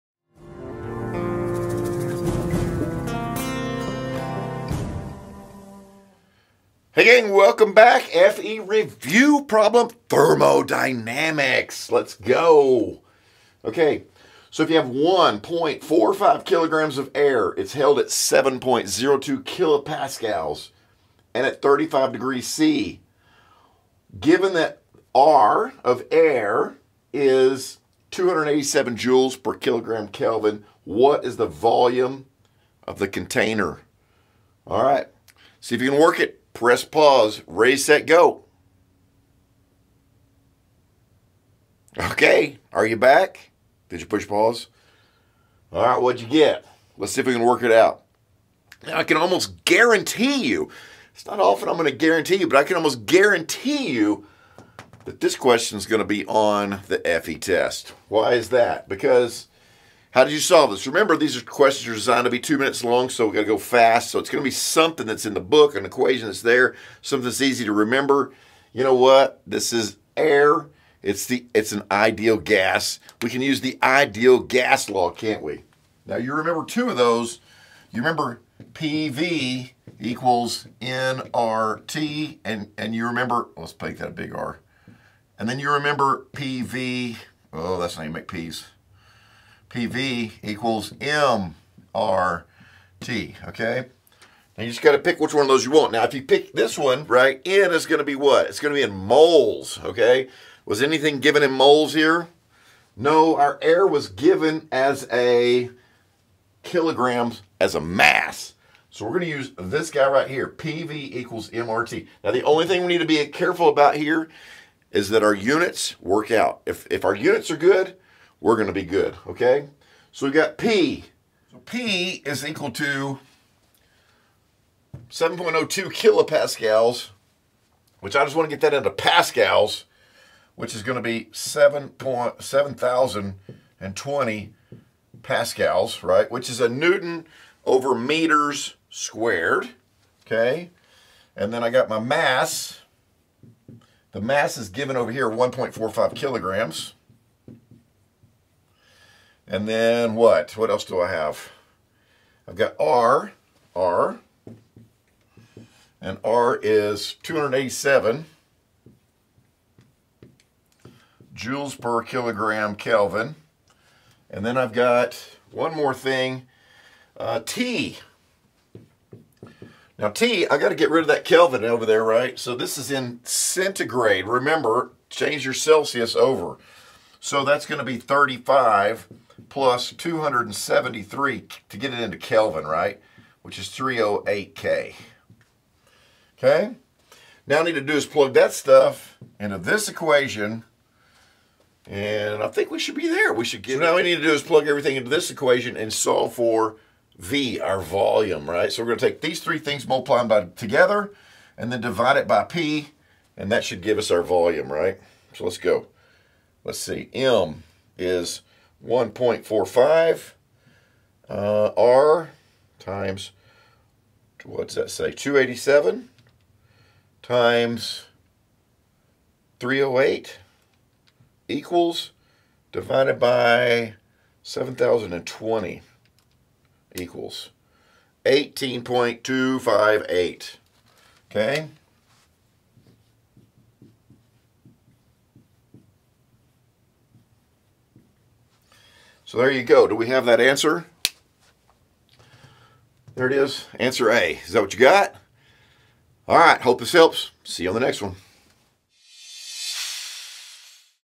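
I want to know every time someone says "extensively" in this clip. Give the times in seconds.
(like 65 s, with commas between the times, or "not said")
not said.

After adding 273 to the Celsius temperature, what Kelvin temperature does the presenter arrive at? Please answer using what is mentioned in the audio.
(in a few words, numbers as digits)
308 K.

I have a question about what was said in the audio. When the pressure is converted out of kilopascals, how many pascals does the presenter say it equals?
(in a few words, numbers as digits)
7,020 pascals.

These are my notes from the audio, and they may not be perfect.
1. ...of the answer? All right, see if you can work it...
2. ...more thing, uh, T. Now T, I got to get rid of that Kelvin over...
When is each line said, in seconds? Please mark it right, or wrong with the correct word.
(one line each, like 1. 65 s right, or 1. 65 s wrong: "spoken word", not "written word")
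1. 32 s wrong: "container", not "answer"
2. 165 s right.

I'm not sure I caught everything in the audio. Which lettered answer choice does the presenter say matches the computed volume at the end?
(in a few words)
Answer A.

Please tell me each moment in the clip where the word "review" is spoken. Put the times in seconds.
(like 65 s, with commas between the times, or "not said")
8 s.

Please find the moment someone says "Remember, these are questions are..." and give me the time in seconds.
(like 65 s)
60 s.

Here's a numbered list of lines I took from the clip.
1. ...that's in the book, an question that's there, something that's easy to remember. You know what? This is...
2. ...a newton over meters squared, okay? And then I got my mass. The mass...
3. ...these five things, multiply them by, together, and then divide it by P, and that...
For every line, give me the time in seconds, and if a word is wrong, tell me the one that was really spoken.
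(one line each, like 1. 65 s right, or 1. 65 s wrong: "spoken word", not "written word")
1. 65 s wrong: "equation", not "question"
2. 136 s right
3. 199 s wrong: "three", not "five".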